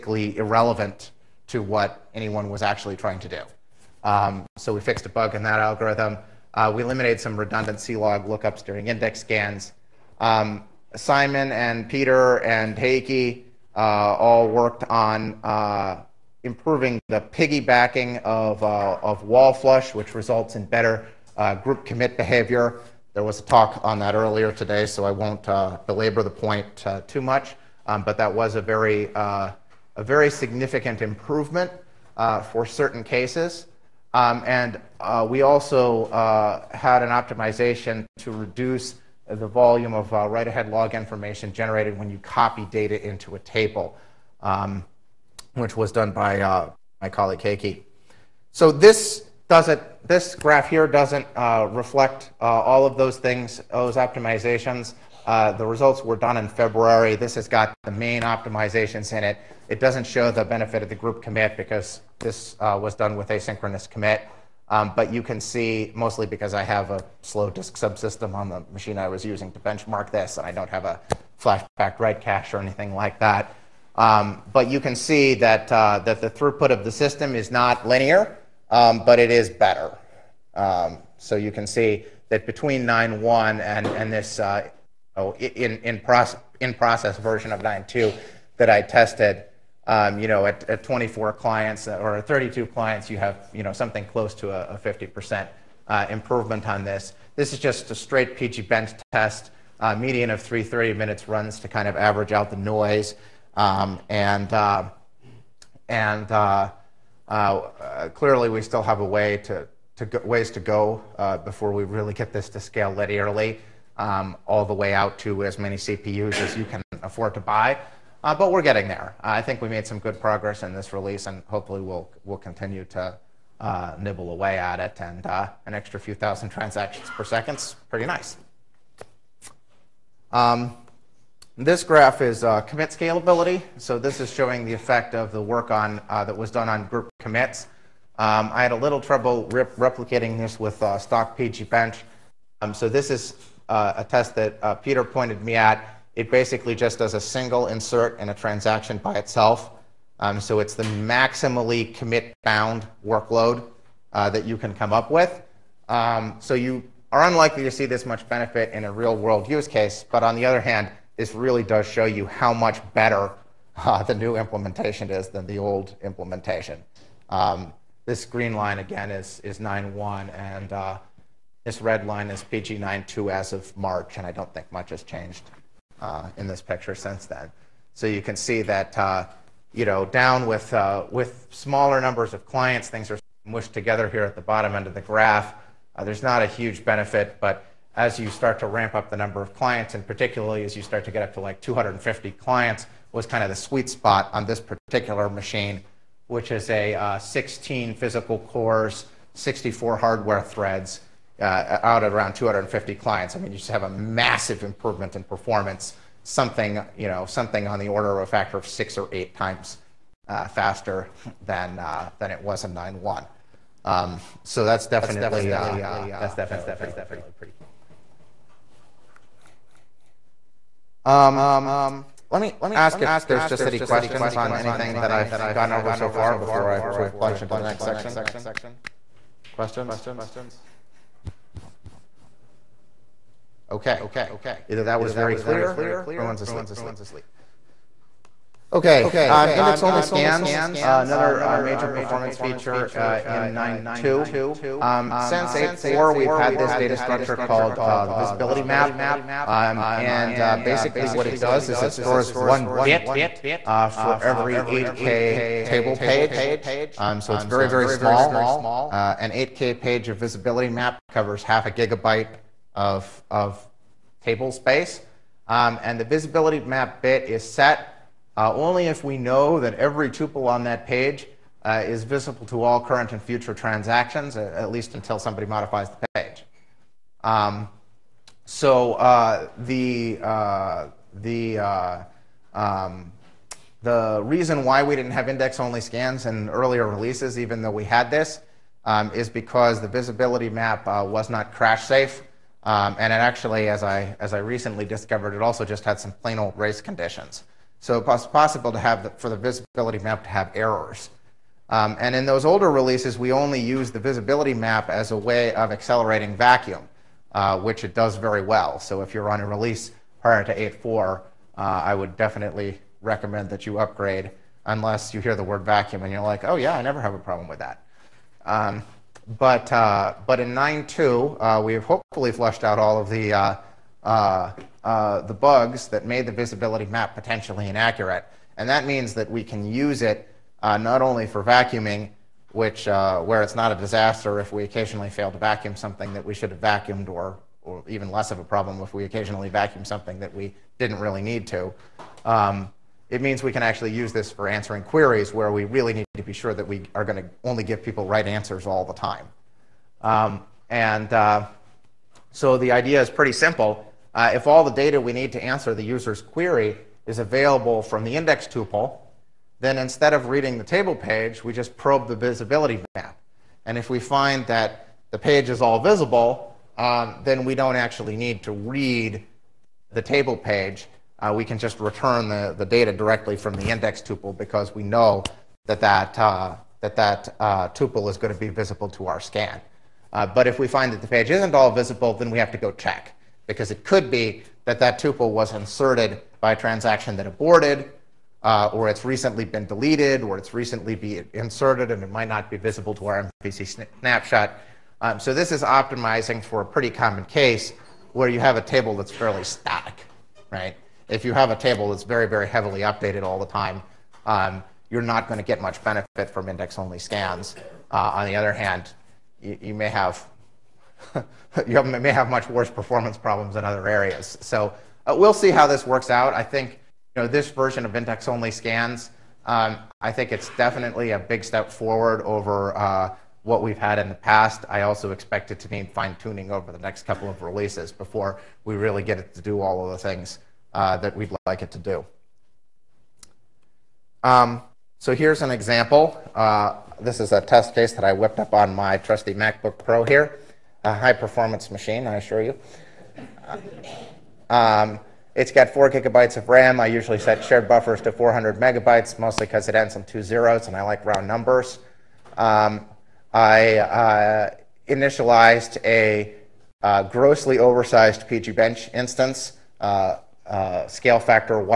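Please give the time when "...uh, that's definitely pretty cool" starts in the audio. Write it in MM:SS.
03:35.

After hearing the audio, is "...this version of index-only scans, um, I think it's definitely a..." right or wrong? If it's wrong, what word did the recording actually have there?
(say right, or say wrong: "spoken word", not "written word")
right.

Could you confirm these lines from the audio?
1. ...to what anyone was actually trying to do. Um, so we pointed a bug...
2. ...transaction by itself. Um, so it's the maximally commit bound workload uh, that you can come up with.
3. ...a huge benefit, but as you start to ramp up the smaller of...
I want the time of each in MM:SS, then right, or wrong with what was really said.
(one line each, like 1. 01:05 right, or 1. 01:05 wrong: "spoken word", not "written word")
1. 00:01 wrong: "fixed", not "pointed"
2. 02:28 right
3. 03:06 wrong: "number", not "smaller".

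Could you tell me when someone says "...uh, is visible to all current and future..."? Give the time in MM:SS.
04:31.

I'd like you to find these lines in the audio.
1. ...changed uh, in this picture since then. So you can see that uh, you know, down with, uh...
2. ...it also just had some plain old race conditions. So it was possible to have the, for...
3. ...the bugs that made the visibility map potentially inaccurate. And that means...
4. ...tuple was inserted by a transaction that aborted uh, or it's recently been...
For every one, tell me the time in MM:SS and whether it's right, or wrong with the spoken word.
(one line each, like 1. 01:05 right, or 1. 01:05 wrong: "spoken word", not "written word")
1. 02:55 right
2. 04:55 right
3. 05:25 right
4. 06:24 right.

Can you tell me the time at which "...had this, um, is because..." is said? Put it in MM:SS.
04:47.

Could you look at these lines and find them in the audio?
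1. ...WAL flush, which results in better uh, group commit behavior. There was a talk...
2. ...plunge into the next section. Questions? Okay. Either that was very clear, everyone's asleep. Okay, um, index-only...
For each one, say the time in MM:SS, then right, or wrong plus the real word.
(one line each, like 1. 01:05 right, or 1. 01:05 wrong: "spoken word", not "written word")
1. 00:19 right
2. 03:47 right.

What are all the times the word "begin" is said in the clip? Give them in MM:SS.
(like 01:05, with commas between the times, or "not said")
not said.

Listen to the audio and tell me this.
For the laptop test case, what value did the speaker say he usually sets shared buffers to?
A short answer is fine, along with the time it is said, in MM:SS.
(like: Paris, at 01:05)
400 megabytes, at 07:28.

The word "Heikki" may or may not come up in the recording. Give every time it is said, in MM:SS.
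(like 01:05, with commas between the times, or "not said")
00:12, 00:47.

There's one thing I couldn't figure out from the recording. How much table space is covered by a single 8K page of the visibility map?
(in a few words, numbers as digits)
half a gigabyte.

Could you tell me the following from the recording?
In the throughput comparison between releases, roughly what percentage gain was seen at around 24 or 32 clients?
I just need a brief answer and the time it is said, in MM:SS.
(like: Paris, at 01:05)
50%, at 01:34.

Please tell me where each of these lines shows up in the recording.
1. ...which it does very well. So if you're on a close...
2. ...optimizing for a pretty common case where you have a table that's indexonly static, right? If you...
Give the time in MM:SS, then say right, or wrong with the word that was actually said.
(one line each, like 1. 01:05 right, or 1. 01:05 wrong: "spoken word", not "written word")
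1. 05:07 wrong: "release", not "close"
2. 06:35 wrong: "fairly", not "indexonly".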